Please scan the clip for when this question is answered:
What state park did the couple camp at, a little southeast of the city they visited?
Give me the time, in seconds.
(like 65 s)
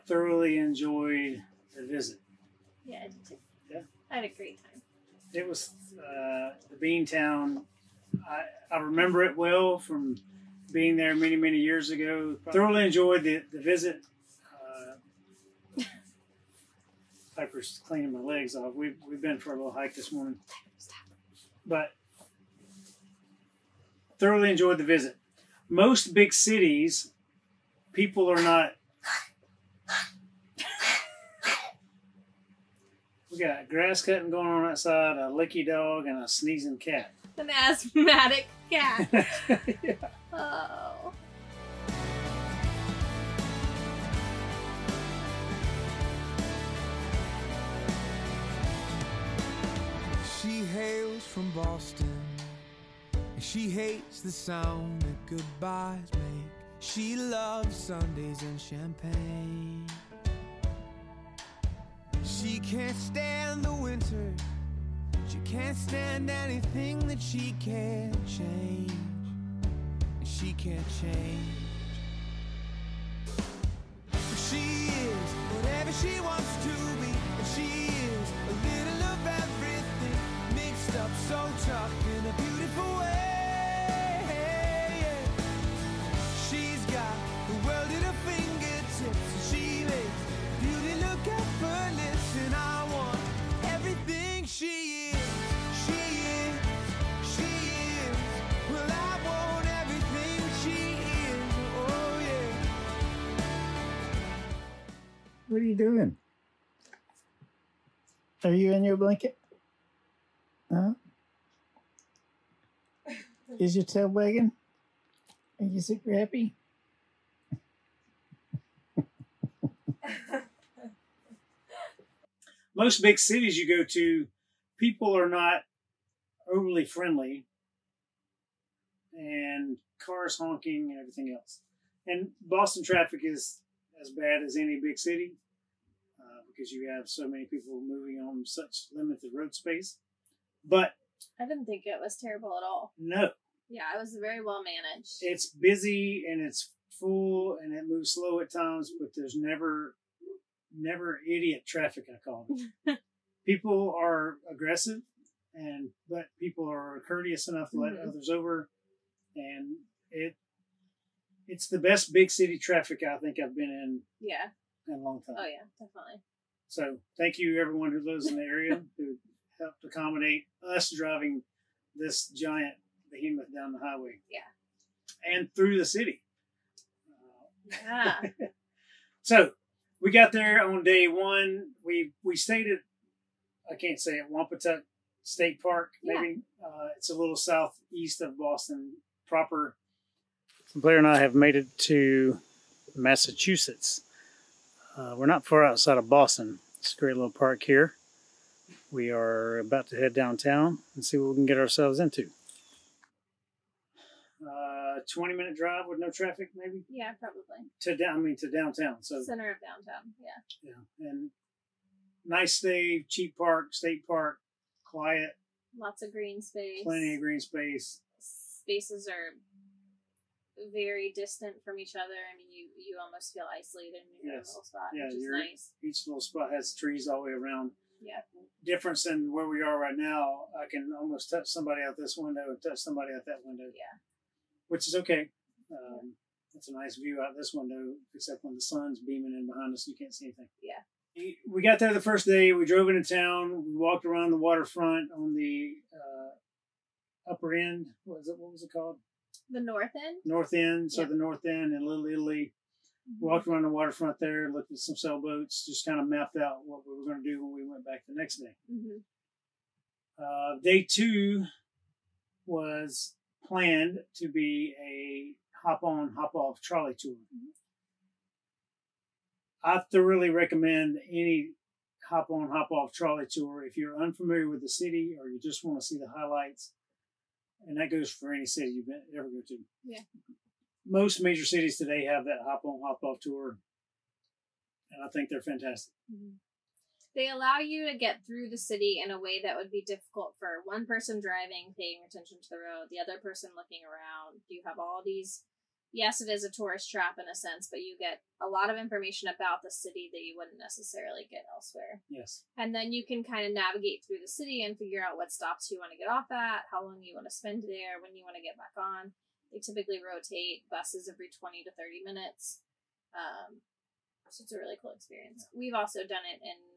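184 s.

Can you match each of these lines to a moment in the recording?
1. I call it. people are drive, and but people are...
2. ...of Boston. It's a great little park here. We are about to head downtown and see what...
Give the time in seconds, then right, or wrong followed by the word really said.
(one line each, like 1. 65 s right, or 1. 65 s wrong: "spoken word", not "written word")
1. 152 s wrong: "aggressive", not "drive"
2. 195 s right.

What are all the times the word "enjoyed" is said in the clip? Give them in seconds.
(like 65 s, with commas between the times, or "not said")
0 s, 12 s, 24 s.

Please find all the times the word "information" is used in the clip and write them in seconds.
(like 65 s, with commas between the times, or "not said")
298 s.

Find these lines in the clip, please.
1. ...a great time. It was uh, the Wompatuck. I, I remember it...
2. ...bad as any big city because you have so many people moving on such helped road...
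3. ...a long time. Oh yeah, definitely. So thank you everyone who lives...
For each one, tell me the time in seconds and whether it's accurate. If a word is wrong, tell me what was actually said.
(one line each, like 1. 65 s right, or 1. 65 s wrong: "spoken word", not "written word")
1. 4 s wrong: "Town", not "Wompatuck"
2. 134 s wrong: "limited", not "helped"
3. 164 s right.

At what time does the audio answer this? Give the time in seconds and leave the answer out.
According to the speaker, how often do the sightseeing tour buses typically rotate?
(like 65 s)
311 s.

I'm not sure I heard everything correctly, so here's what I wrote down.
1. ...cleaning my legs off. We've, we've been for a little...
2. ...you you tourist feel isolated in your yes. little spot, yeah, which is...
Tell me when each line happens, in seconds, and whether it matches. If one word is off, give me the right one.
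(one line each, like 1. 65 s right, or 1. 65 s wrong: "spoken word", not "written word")
1. 17 s right
2. 222 s wrong: "almost", not "tourist".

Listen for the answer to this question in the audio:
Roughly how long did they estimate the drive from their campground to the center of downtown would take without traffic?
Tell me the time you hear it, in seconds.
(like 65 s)
205 s.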